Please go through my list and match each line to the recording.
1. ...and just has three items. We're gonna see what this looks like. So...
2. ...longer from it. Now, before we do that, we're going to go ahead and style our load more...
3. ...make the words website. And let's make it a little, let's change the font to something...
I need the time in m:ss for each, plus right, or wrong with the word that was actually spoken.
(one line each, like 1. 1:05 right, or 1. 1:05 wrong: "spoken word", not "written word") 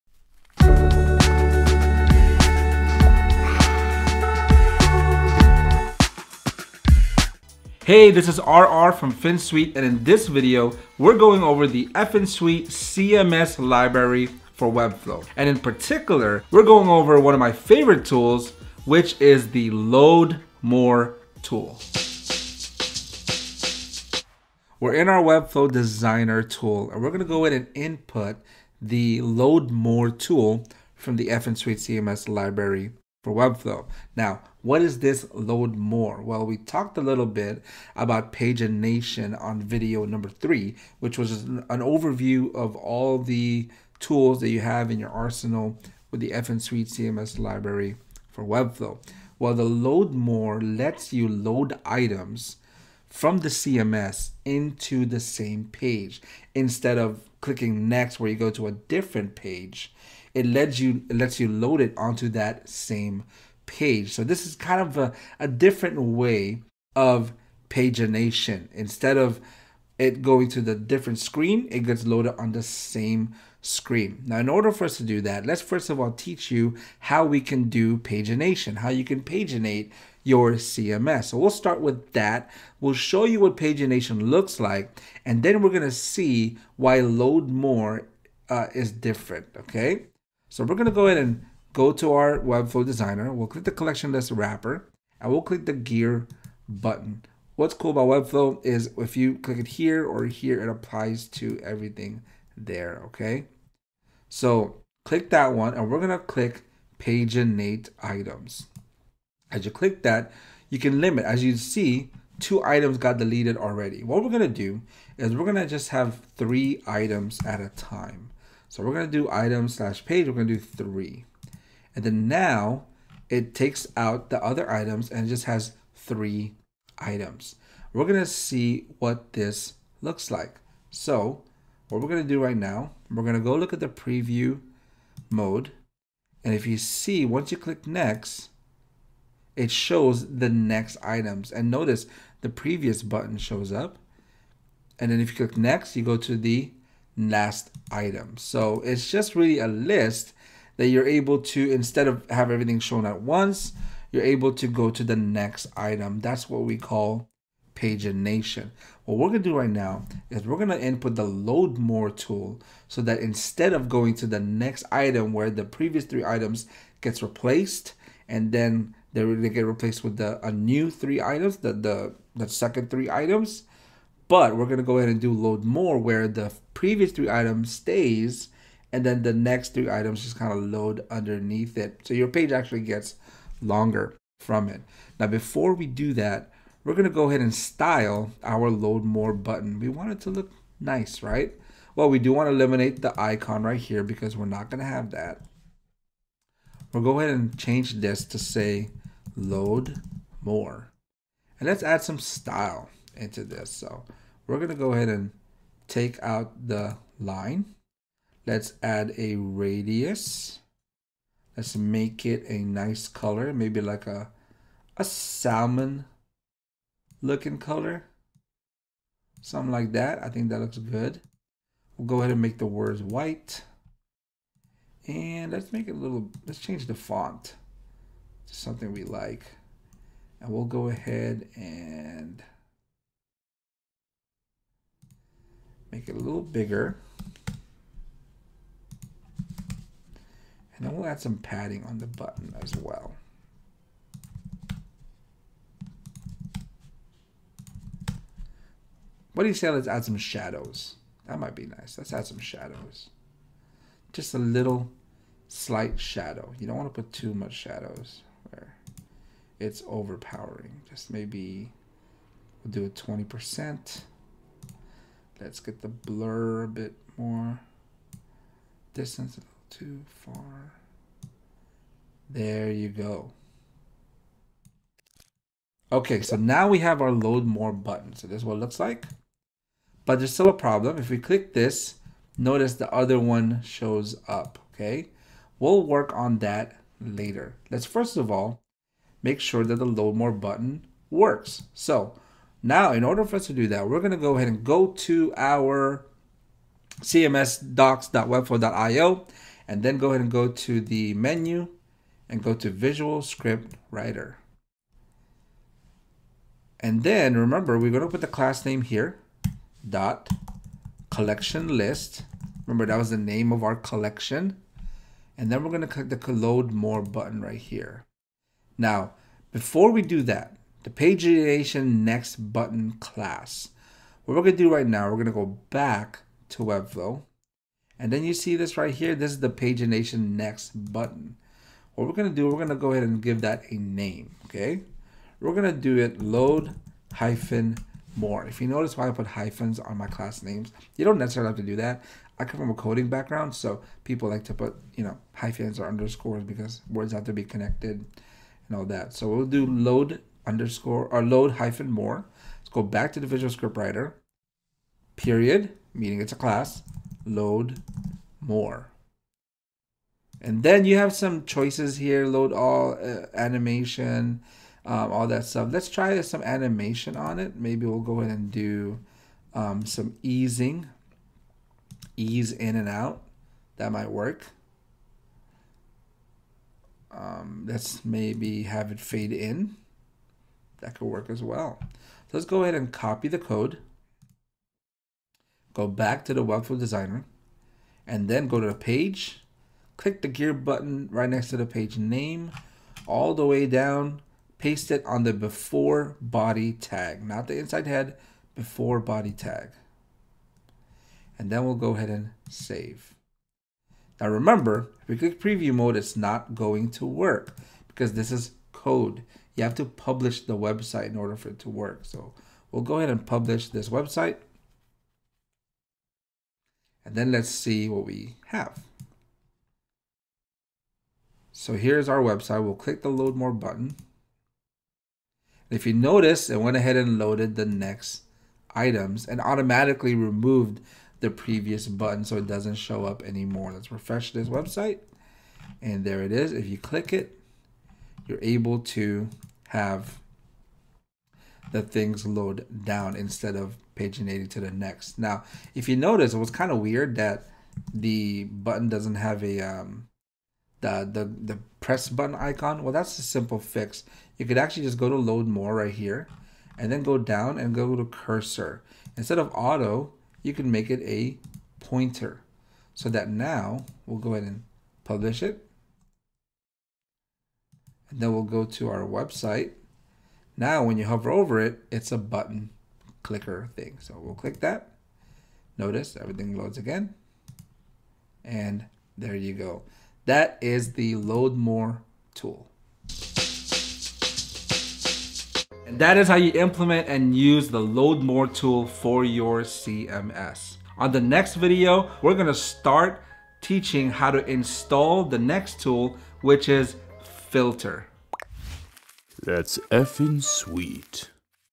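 1. 2:05 right
2. 3:03 right
3. 3:42 wrong: "white", not "website".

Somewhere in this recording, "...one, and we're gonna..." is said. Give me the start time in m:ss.
1:45.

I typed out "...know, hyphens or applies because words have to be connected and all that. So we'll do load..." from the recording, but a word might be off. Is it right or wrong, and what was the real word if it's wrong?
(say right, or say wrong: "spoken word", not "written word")
wrong: "underscores", not "applies".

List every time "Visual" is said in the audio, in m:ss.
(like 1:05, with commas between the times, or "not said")
5:02, 5:53.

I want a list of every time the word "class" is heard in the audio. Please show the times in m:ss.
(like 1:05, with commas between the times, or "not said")
5:08, 5:22, 5:40, 5:56.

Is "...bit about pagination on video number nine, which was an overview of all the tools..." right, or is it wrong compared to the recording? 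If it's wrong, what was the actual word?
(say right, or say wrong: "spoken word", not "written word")
wrong: "three", not "nine".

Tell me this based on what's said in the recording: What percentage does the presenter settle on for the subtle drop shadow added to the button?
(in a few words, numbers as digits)
20%.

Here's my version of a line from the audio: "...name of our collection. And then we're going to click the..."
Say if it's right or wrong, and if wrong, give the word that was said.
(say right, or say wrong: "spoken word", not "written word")
right.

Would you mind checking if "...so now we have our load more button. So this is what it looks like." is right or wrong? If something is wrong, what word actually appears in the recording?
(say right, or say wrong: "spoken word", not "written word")
right.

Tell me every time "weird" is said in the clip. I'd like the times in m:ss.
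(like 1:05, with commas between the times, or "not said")
7:26.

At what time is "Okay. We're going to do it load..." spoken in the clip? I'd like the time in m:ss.
5:34.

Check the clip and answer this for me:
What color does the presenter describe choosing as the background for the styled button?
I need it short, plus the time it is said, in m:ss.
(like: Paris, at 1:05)
salmon, at 3:35.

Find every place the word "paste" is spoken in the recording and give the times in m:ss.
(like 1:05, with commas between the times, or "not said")
6:34.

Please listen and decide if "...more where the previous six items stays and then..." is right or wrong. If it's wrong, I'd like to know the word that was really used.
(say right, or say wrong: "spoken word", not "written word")
wrong: "three", not "six".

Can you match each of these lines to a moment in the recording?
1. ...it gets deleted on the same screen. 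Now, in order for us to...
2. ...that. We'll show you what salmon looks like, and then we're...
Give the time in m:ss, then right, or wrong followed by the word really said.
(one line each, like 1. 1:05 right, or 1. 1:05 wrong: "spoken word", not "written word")
1. 1:11 wrong: "loaded", not "deleted"
2. 1:22 wrong: "pagination", not "salmon".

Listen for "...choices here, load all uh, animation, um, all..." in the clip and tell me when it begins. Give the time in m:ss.
6:01.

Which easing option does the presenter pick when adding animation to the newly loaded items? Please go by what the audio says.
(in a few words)
ease in and out.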